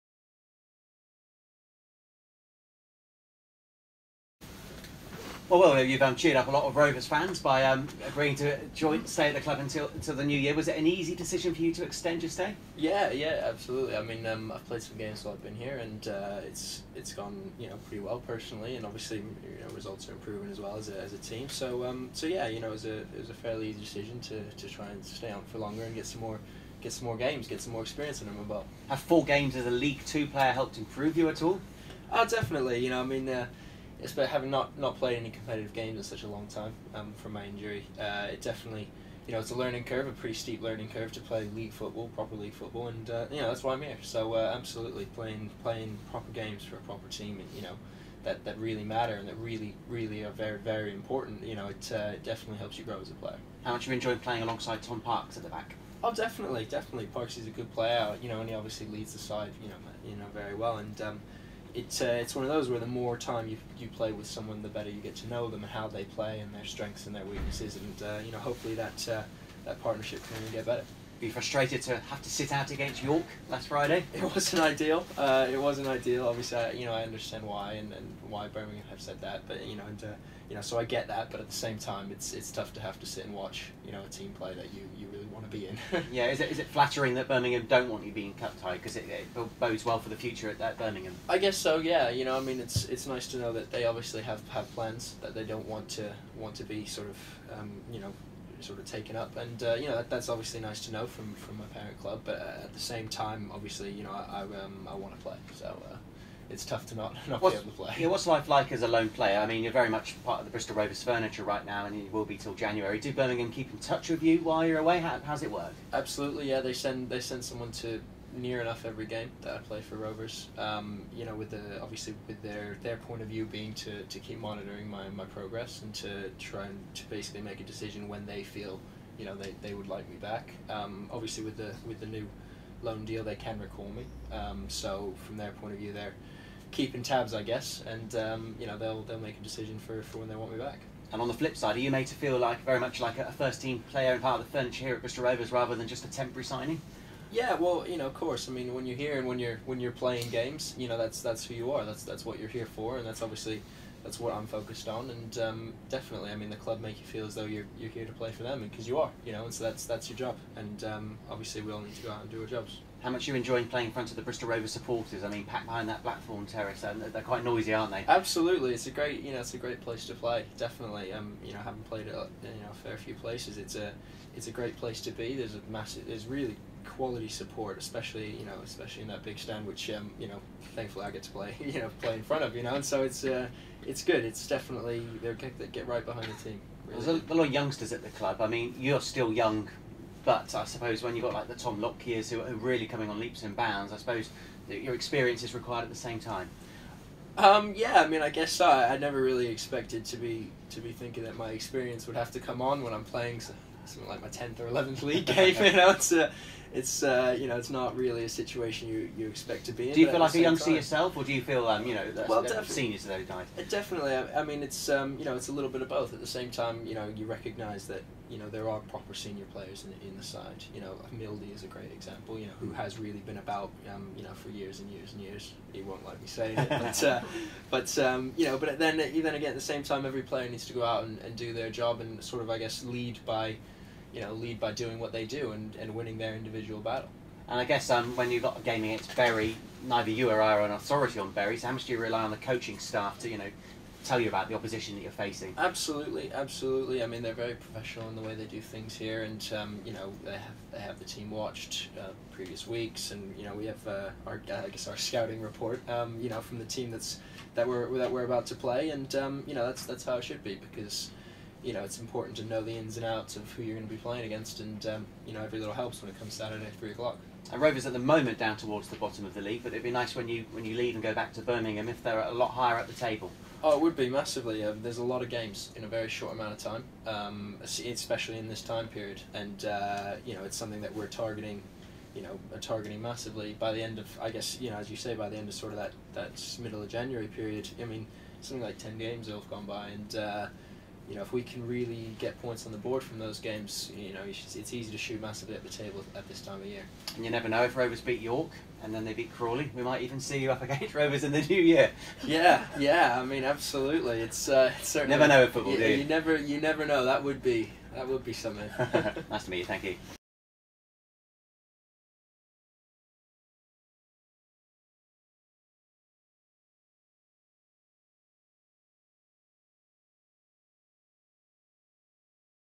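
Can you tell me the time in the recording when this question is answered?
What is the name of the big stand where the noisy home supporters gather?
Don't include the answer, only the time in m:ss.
2:46.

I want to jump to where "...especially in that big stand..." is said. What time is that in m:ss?
2:58.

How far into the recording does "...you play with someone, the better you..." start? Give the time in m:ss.
1:03.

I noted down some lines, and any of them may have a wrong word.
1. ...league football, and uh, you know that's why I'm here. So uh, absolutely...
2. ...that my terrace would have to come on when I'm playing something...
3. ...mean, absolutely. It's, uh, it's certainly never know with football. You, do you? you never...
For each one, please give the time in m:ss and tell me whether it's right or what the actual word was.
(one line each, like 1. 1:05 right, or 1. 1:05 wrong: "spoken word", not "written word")
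1. 0:42 right
2. 3:21 wrong: "experience", not "terrace"
3. 5:03 right.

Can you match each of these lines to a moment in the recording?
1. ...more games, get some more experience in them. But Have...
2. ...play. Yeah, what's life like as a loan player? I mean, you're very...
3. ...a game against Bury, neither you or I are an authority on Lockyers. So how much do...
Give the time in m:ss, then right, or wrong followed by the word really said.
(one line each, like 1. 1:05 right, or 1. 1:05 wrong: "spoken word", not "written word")
1. 0:27 right
2. 1:47 right
3. 3:58 wrong: "Bury", not "Lockyers".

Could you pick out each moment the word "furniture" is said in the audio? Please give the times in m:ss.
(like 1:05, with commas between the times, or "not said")
1:51, 2:24.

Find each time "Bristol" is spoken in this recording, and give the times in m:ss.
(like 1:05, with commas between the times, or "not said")
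1:50, 2:25, 2:44.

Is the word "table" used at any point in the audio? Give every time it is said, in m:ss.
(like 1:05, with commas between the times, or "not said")
4:32, 4:55.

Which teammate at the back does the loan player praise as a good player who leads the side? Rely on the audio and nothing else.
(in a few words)
Tom Parkes.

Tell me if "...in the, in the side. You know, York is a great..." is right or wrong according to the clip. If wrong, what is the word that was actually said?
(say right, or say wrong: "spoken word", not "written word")
wrong: "Mildy", not "York".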